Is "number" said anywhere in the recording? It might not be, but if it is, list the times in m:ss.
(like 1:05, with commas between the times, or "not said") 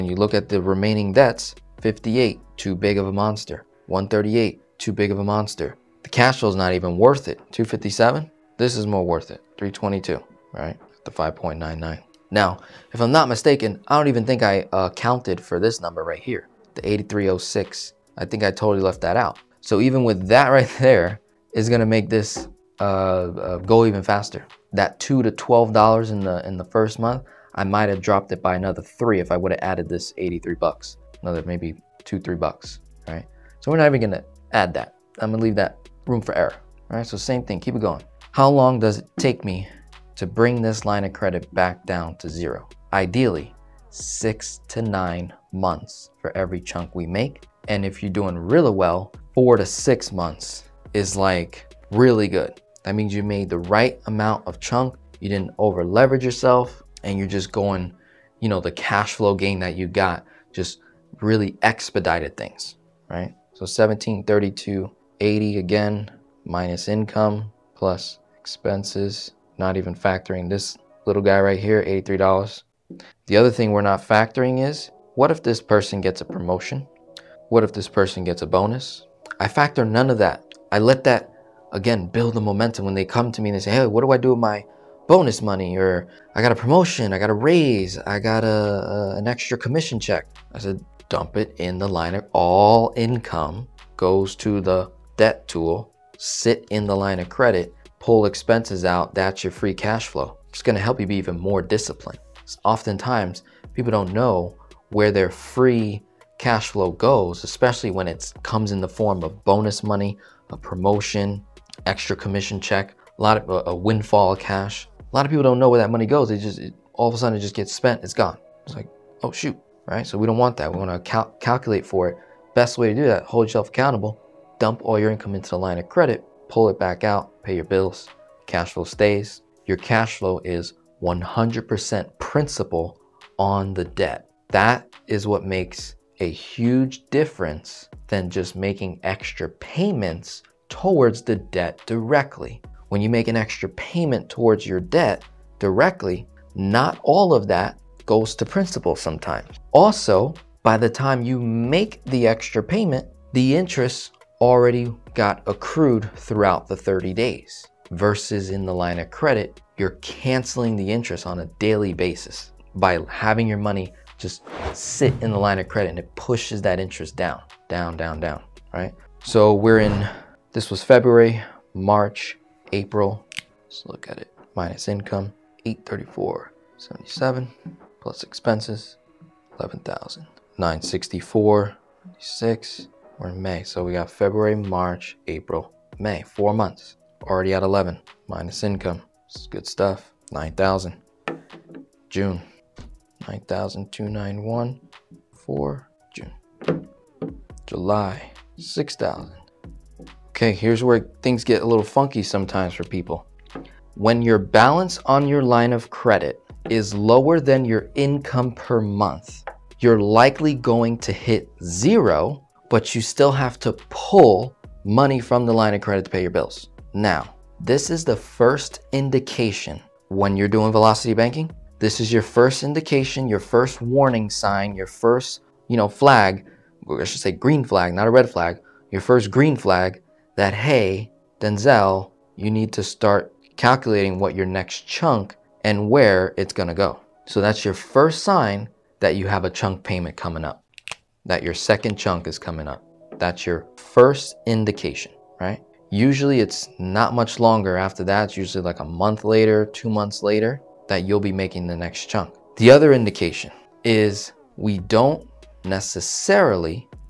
0:15.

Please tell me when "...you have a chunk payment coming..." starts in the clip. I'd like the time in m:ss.
3:59.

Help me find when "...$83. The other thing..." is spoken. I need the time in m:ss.
1:11.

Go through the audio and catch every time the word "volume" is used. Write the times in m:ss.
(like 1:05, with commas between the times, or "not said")
not said.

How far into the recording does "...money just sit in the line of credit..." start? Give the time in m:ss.
2:43.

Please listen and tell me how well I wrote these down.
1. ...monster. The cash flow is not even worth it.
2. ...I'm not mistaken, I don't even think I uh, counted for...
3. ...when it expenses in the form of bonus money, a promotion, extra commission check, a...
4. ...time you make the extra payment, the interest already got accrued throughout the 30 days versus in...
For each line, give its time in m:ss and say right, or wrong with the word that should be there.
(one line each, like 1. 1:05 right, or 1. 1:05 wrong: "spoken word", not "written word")
1. 0:05 right
2. 0:13 right
3. 1:47 wrong: "comes", not "expenses"
4. 2:30 right.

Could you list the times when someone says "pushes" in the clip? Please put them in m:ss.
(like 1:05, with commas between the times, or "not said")
2:46.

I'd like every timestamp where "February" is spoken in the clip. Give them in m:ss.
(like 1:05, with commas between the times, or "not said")
2:50, 3:04.